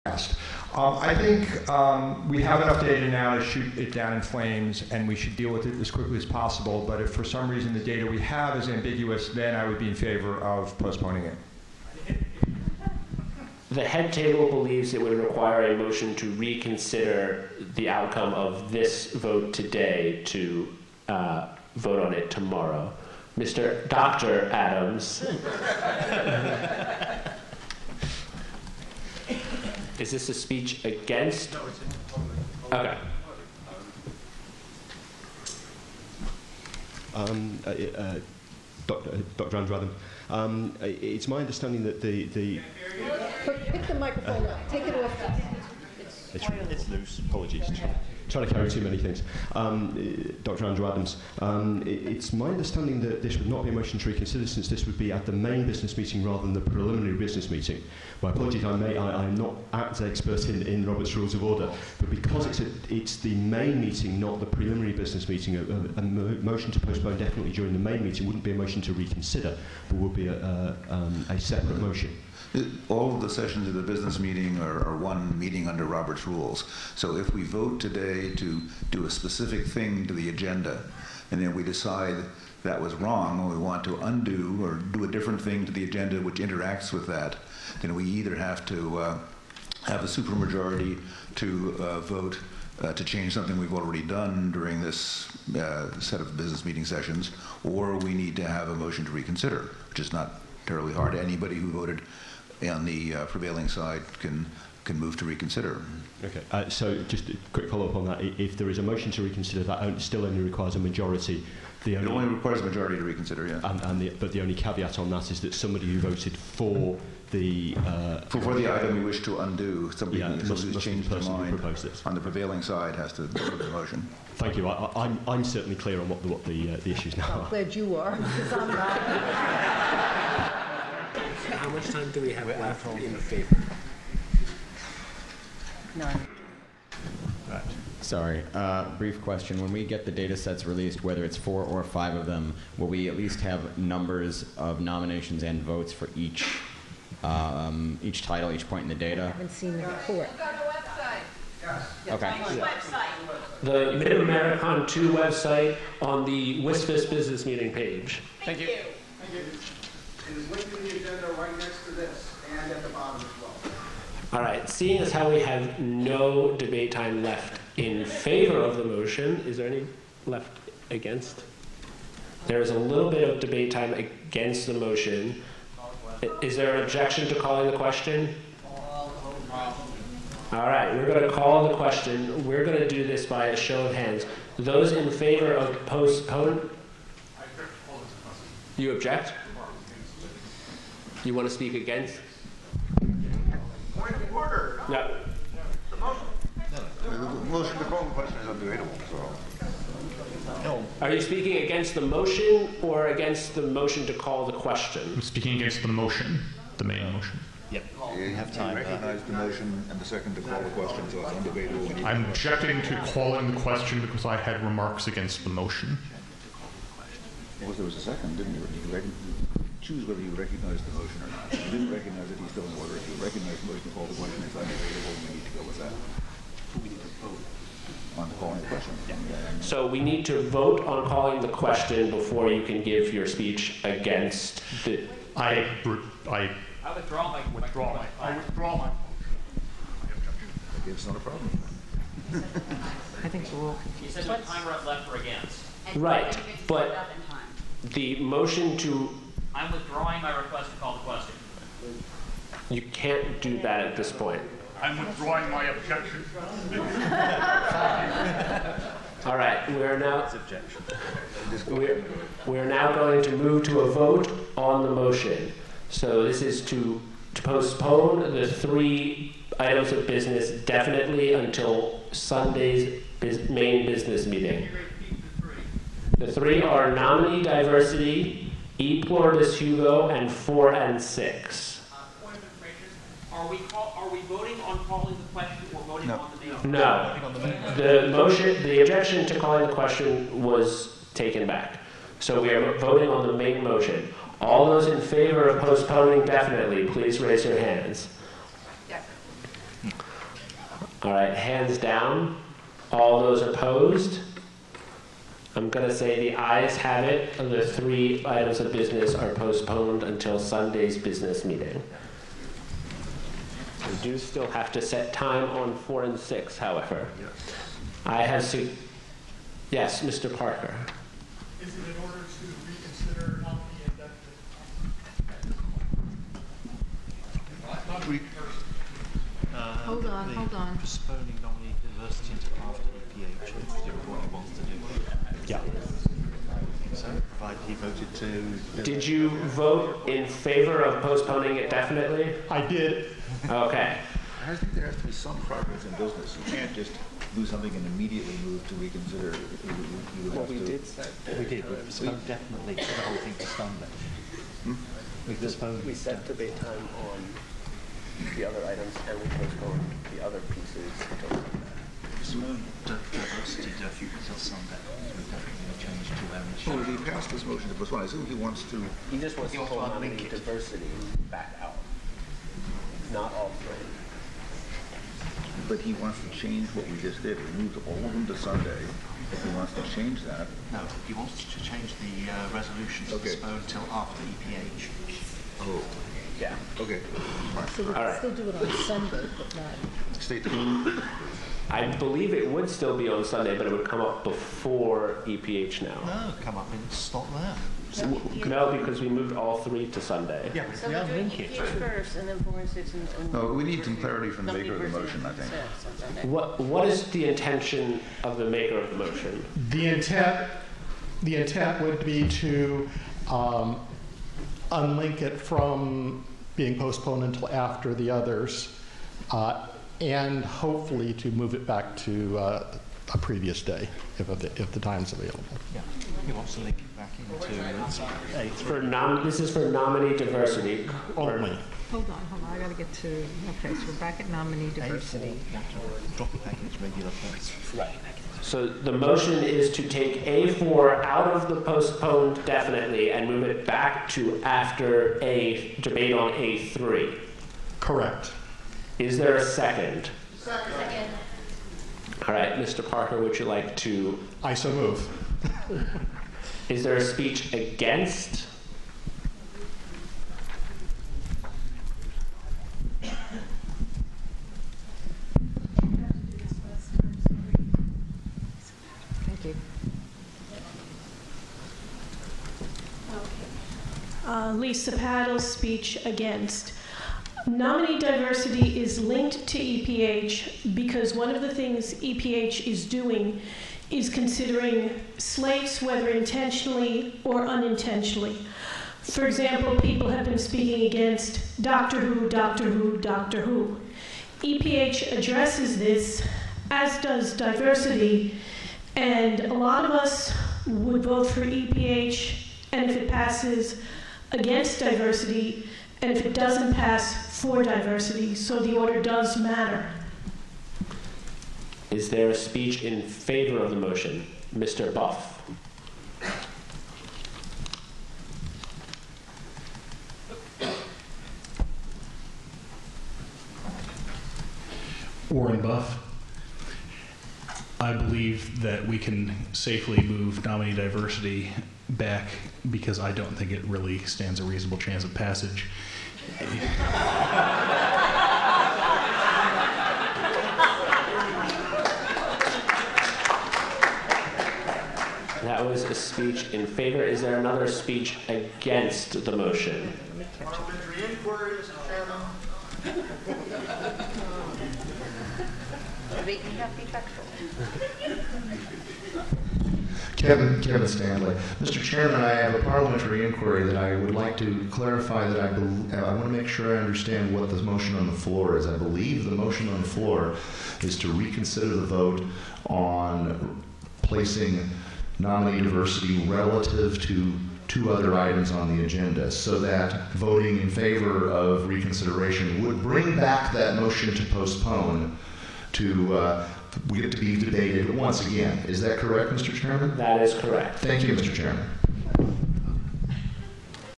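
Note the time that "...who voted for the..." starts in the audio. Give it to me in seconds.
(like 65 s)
115 s.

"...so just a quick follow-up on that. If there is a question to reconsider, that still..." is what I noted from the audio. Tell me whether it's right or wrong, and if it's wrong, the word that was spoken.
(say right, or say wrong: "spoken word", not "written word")
wrong: "motion", not "question".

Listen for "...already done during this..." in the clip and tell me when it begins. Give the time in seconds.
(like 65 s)
93 s.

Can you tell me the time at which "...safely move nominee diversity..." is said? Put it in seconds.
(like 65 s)
529 s.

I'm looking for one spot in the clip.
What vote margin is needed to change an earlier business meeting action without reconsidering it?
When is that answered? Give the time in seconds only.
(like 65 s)
90 s.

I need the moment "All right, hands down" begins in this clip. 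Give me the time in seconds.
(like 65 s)
301 s.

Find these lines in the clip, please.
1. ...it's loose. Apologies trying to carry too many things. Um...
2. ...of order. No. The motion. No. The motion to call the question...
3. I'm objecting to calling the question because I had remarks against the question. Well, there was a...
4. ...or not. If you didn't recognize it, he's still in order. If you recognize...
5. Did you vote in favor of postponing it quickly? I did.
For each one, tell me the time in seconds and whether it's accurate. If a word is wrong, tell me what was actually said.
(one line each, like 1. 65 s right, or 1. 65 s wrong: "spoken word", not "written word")
1. 46 s right
2. 194 s right
3. 212 s wrong: "motion", not "question"
4. 221 s right
5. 338 s wrong: "definitely", not "quickly".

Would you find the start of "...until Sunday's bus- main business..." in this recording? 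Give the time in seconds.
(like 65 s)
271 s.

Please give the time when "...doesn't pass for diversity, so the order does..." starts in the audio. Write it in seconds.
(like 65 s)
506 s.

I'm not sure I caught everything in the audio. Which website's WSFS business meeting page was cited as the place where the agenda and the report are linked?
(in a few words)
MidAmeriCon 2.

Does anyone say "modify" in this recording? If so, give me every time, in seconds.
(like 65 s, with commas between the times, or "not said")
not said.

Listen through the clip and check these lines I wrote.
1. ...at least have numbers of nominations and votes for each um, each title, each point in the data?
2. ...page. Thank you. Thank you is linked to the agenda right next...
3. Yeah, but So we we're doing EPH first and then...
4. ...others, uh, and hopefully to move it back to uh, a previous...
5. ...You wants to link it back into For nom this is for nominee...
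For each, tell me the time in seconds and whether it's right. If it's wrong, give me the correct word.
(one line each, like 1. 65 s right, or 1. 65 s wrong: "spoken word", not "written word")
1. 143 s right
2. 157 s right
3. 400 s right
4. 418 s right
5. 426 s right.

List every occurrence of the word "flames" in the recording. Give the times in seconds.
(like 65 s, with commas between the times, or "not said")
4 s.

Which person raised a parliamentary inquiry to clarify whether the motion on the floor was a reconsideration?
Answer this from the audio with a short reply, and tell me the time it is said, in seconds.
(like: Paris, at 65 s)
Kevin Standlee, at 560 s.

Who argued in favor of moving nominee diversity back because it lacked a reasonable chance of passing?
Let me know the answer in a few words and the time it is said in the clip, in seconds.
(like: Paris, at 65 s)
Warren Buff, at 525 s.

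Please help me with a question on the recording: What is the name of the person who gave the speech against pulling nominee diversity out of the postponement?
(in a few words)
Lisa Padol.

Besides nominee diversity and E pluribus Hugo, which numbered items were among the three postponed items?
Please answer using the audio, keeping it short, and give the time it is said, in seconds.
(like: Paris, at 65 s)
4 and 6, at 280 s.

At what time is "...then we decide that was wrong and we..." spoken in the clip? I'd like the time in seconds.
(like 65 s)
81 s.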